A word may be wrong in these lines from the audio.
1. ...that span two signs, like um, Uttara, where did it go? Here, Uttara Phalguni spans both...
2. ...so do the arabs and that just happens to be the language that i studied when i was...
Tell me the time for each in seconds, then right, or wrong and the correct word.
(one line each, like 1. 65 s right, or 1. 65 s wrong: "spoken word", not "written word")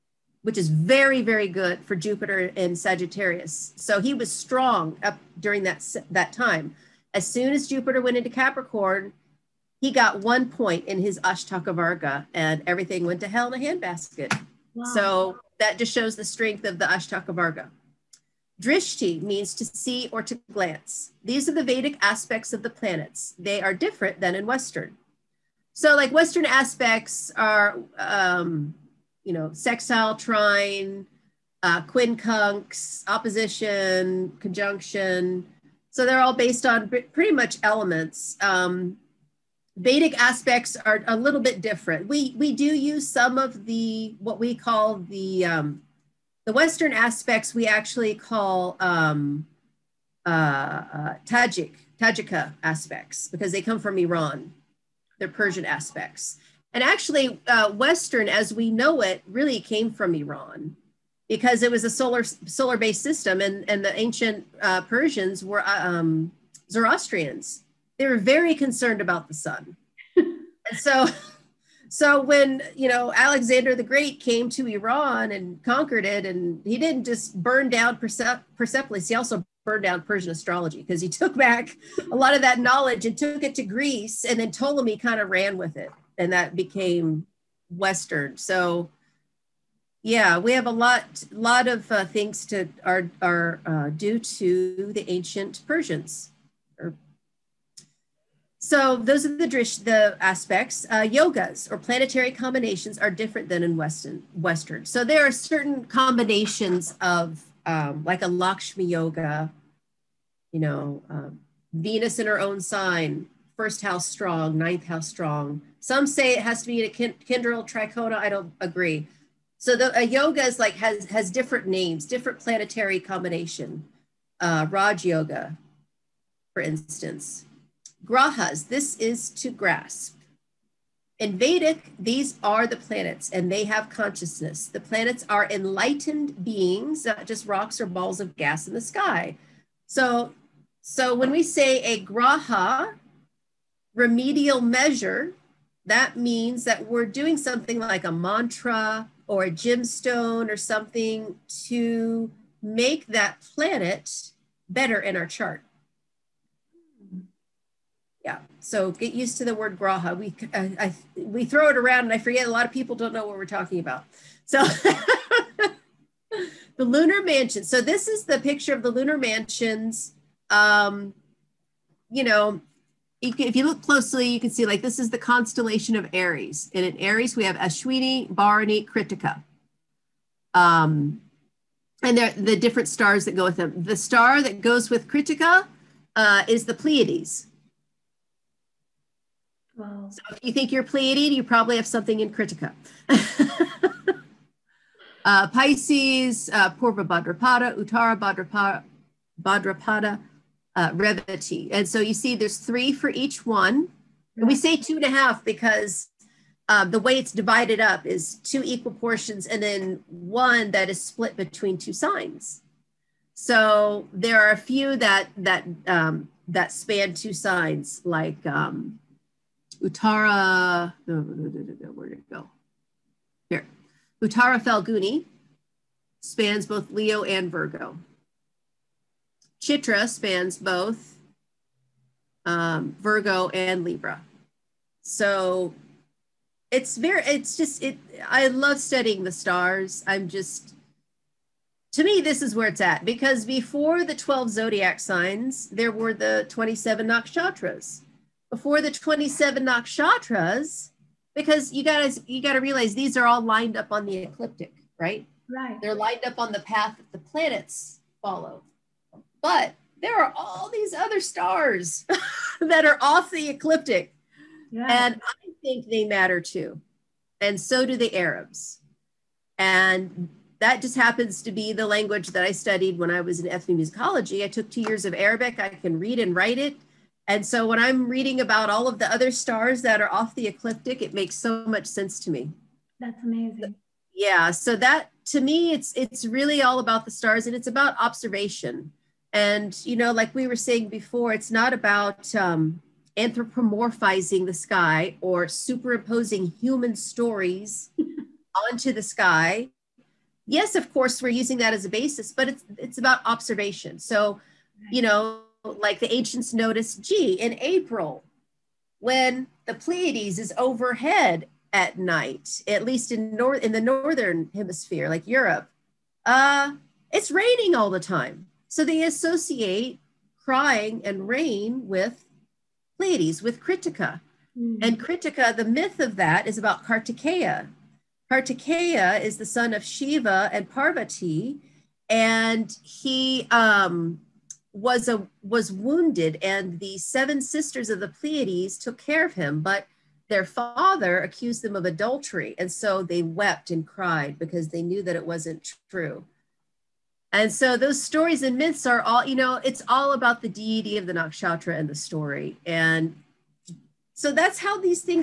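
1. 216 s right
2. 267 s right.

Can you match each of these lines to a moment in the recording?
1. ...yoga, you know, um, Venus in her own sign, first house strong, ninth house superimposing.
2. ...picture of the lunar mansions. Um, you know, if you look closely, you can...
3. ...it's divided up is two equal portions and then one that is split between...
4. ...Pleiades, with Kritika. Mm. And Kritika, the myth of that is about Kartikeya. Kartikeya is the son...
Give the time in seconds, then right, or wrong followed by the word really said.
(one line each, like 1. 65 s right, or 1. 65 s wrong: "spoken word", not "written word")
1. 108 s wrong: "strong", not "superimposing"
2. 168 s right
3. 207 s right
4. 322 s right.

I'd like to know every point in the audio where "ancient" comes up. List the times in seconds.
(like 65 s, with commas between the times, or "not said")
63 s, 95 s, 306 s.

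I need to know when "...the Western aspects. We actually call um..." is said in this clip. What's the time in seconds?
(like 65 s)
46 s.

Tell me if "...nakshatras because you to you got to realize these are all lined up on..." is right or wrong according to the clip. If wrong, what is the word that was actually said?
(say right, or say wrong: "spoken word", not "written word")
right.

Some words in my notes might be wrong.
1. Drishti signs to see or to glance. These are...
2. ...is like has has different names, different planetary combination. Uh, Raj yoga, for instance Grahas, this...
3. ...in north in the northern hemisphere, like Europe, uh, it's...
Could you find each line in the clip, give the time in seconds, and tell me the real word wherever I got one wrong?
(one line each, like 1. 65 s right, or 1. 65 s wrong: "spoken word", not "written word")
1. 18 s wrong: "means", not "signs"
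2. 120 s right
3. 313 s right.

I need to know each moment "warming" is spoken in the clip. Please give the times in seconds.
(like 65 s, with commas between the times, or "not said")
not said.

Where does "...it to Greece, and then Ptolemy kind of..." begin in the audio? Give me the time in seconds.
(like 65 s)
83 s.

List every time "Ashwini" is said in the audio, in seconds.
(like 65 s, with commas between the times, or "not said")
177 s.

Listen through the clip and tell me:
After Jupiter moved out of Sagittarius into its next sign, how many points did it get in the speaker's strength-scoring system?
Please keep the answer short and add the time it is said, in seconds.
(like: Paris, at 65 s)
1, at 10 s.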